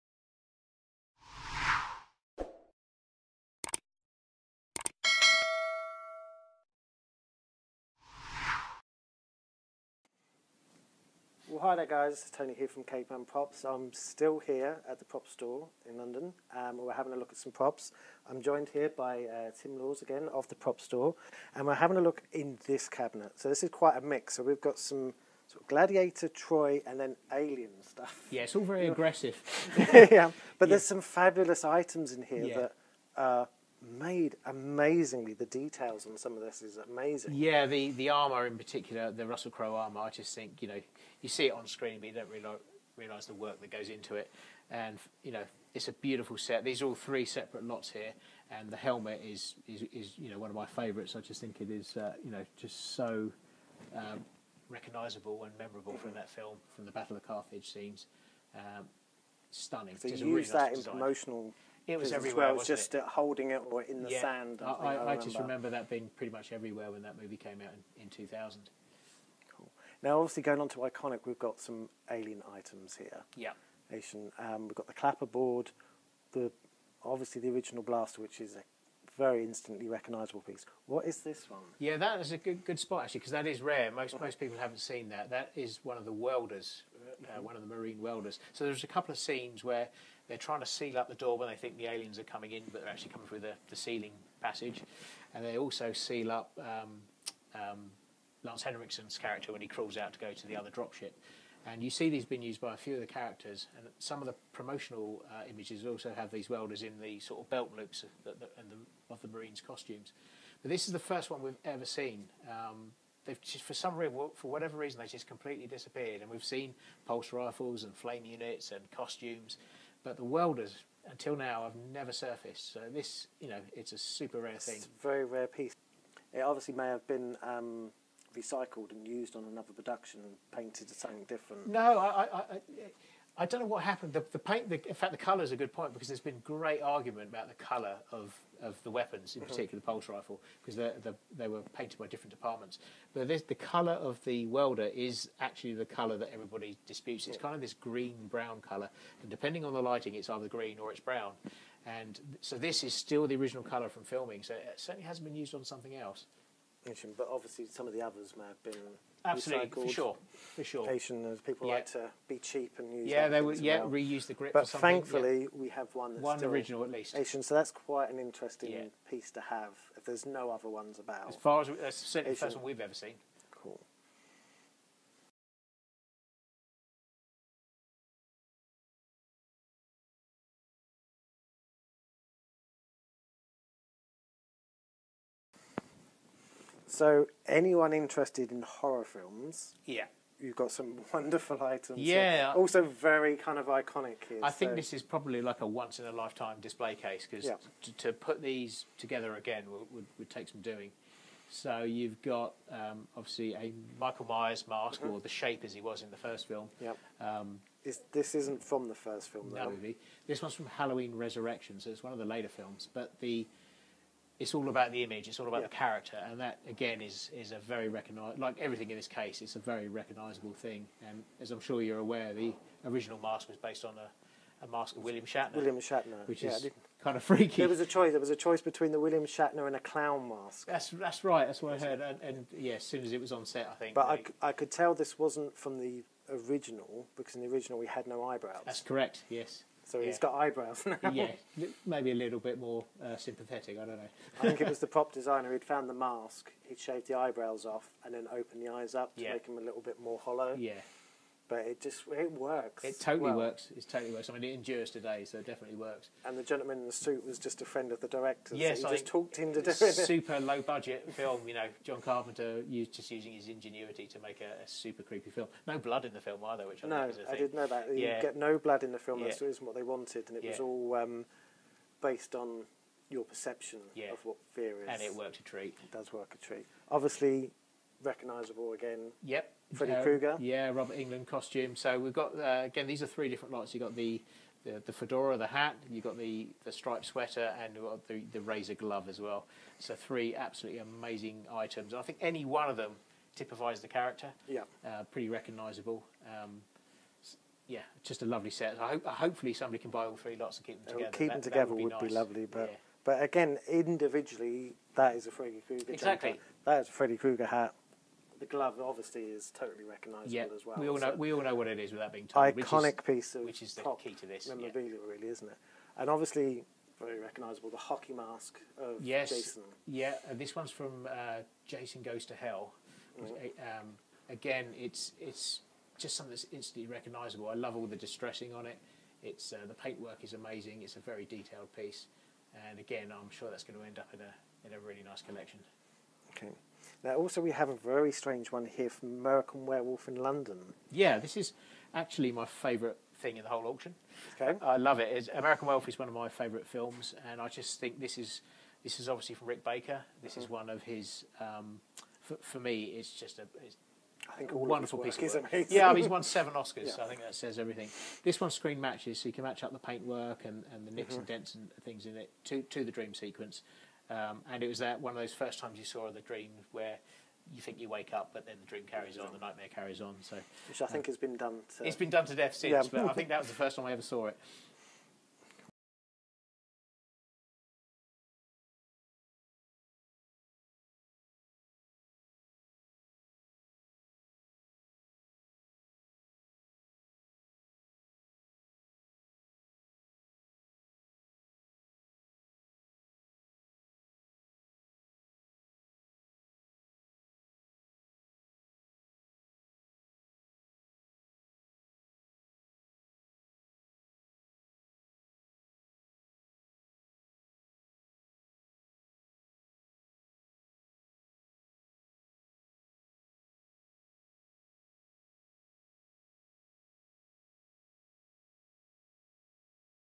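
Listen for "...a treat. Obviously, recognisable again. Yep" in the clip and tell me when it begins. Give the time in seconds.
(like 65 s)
276 s.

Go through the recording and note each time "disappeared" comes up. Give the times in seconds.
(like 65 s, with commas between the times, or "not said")
115 s.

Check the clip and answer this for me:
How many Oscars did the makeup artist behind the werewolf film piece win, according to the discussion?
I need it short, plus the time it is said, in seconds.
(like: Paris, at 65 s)
7, at 356 s.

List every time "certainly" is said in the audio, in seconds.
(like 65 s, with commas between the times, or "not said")
154 s, 171 s.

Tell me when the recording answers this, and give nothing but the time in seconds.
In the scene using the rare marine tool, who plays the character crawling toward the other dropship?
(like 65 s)
98 s.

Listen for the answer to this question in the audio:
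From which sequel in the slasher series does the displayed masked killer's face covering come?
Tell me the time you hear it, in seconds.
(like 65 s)
210 s.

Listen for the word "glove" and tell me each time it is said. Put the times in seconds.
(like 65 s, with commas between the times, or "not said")
288 s, 308 s.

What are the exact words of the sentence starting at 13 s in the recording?
I'm still here at the prop store in London.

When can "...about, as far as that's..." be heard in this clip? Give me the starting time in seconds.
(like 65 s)
170 s.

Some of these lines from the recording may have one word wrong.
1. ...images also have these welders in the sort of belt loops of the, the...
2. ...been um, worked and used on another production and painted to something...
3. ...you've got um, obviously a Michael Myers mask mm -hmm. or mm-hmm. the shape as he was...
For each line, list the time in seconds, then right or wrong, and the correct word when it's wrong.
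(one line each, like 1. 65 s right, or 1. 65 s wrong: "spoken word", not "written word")
1. 105 s right
2. 127 s wrong: "recycled", not "worked"
3. 201 s right.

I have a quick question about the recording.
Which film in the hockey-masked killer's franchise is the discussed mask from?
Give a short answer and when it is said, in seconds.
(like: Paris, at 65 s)
Jason Goes to Hell, at 321 s.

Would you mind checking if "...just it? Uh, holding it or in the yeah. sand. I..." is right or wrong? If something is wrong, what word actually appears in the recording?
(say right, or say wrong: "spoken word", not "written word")
right.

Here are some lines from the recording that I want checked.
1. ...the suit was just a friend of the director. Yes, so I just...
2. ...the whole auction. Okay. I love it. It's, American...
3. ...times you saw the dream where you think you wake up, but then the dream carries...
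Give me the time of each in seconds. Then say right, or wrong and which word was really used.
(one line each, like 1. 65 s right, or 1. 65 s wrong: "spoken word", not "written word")
1. 256 s right
2. 343 s right
3. 365 s right.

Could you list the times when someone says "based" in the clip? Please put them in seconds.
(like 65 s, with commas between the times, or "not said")
223 s, 272 s.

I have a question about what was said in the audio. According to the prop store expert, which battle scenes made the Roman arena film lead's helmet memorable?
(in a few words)
Battle of Carthage.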